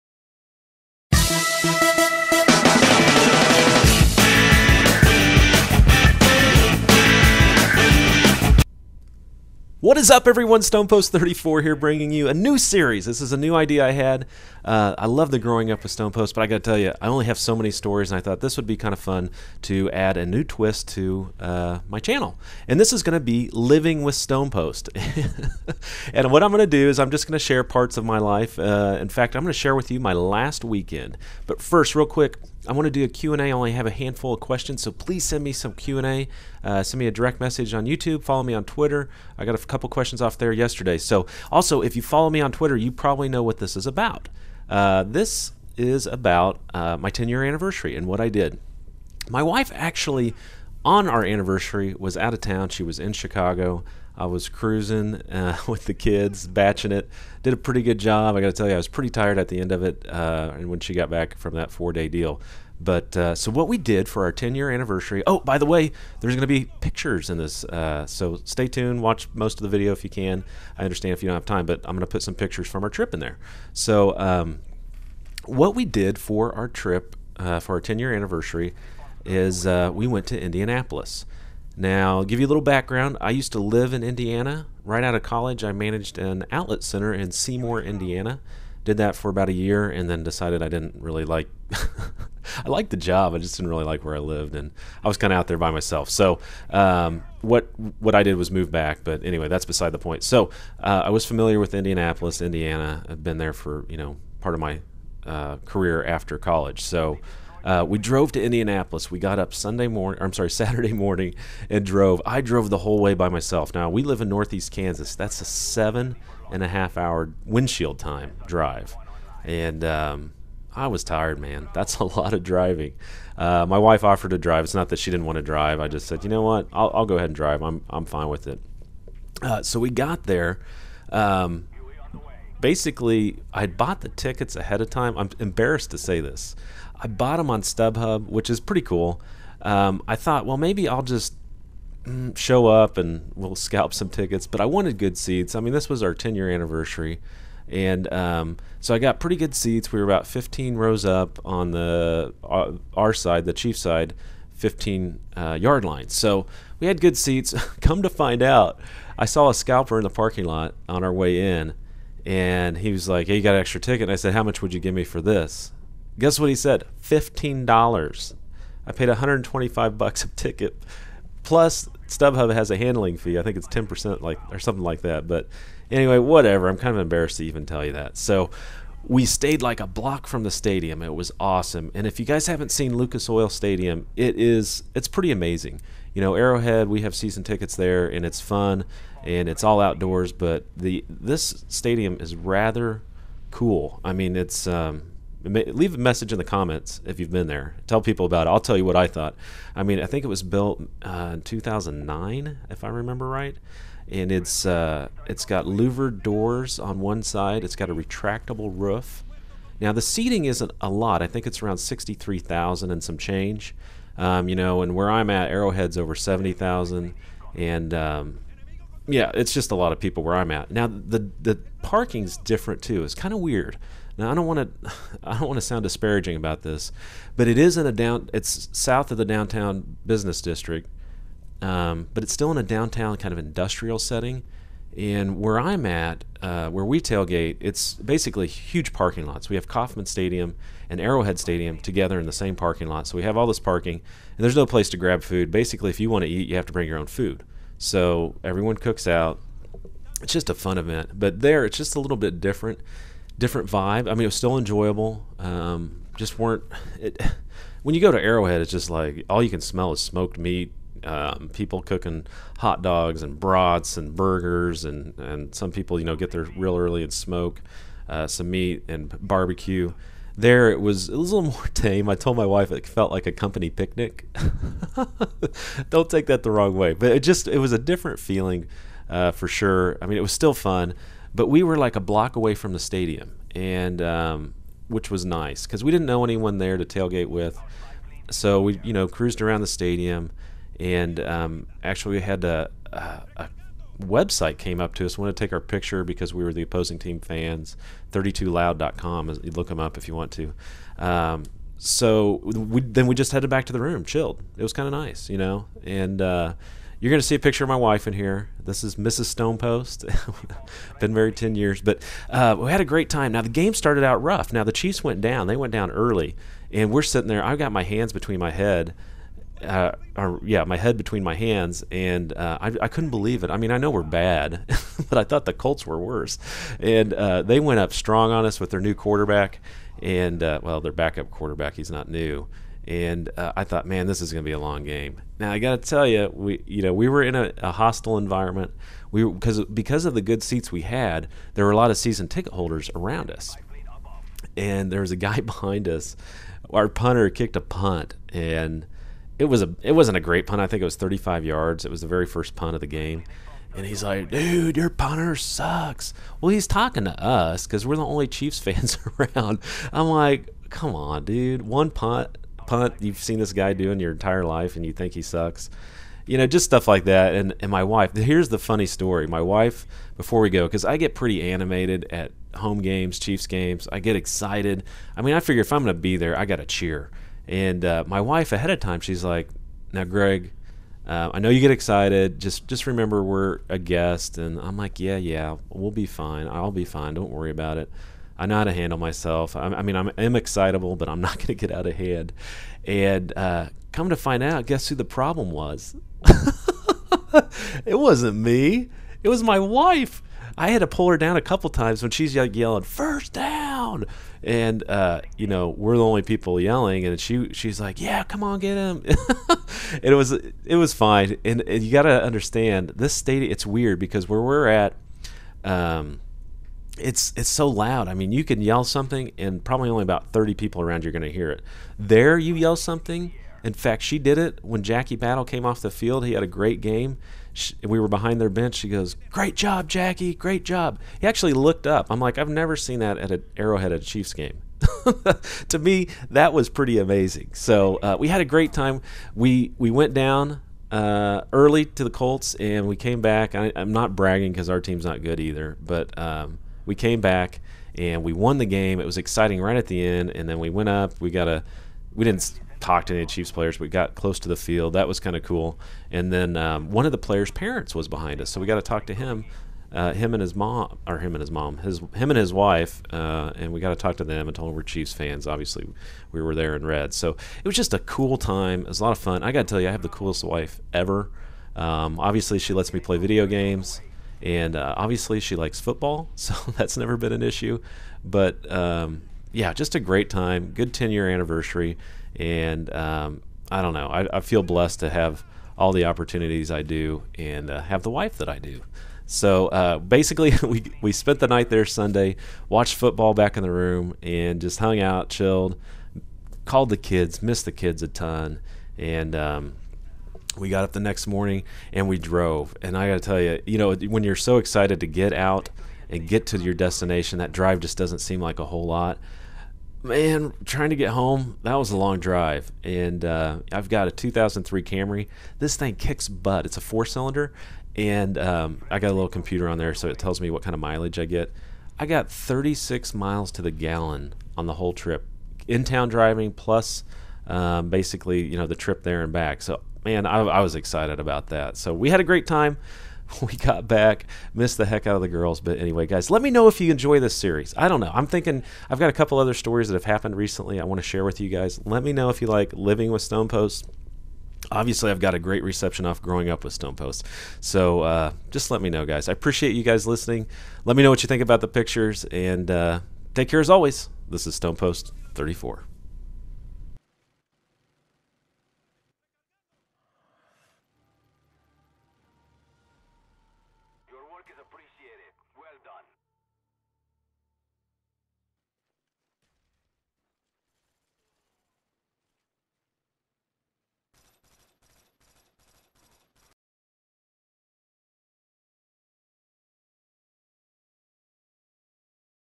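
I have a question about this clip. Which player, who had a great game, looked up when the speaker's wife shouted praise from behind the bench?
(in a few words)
Jackie Battle.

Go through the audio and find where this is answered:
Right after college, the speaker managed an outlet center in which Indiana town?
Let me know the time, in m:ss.
1:27.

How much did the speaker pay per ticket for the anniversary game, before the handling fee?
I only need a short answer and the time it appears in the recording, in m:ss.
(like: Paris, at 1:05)
$125, at 2:49.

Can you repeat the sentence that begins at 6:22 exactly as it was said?
Just just remember we're a guest, and I'm like, yeah, yeah, we'll be fine.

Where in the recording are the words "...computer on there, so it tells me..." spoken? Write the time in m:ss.
8:39.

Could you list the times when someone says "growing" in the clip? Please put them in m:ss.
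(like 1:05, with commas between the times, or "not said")
0:15, 9:06.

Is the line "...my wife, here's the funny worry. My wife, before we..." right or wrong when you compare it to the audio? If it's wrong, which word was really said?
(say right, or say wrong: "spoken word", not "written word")
wrong: "story", not "worry".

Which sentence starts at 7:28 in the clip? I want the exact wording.
It was exciting right at the end, and then we went up.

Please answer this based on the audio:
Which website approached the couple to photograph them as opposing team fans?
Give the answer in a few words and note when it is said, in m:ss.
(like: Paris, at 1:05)
32loud.com, at 4:58.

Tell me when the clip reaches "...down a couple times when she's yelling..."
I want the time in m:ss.
6:41.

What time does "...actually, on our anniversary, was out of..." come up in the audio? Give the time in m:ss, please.
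0:49.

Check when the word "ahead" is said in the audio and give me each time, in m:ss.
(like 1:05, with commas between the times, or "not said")
2:07, 2:14, 6:18.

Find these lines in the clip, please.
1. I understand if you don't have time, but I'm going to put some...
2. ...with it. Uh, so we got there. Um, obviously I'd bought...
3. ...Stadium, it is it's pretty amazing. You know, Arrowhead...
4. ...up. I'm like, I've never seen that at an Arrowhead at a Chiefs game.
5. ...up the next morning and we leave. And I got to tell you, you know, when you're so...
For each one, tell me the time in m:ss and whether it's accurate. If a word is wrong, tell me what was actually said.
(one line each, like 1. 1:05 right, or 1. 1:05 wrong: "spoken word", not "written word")
1. 1:10 right
2. 2:08 wrong: "basically", not "obviously"
3. 3:03 right
4. 7:11 right
5. 8:20 wrong: "drove", not "leave".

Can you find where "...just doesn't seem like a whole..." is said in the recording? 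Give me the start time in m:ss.
8:27.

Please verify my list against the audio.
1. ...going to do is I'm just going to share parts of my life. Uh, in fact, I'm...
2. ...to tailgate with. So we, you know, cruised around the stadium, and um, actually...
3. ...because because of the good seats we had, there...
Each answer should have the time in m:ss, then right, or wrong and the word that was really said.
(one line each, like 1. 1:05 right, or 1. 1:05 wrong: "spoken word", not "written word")
1. 0:26 right
2. 4:46 right
3. 5:39 right.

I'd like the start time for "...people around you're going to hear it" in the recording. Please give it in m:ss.
7:00.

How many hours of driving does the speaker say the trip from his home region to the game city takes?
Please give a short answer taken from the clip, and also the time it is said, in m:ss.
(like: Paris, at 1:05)
7.5 hours, at 1:55.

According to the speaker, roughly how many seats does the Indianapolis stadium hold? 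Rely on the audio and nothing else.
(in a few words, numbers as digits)
63,000.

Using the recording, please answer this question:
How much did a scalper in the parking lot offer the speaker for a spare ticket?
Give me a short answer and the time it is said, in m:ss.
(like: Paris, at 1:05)
$15, at 2:46.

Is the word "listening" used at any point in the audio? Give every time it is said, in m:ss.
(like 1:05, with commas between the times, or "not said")
9:10.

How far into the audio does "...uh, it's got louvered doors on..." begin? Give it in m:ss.
3:24.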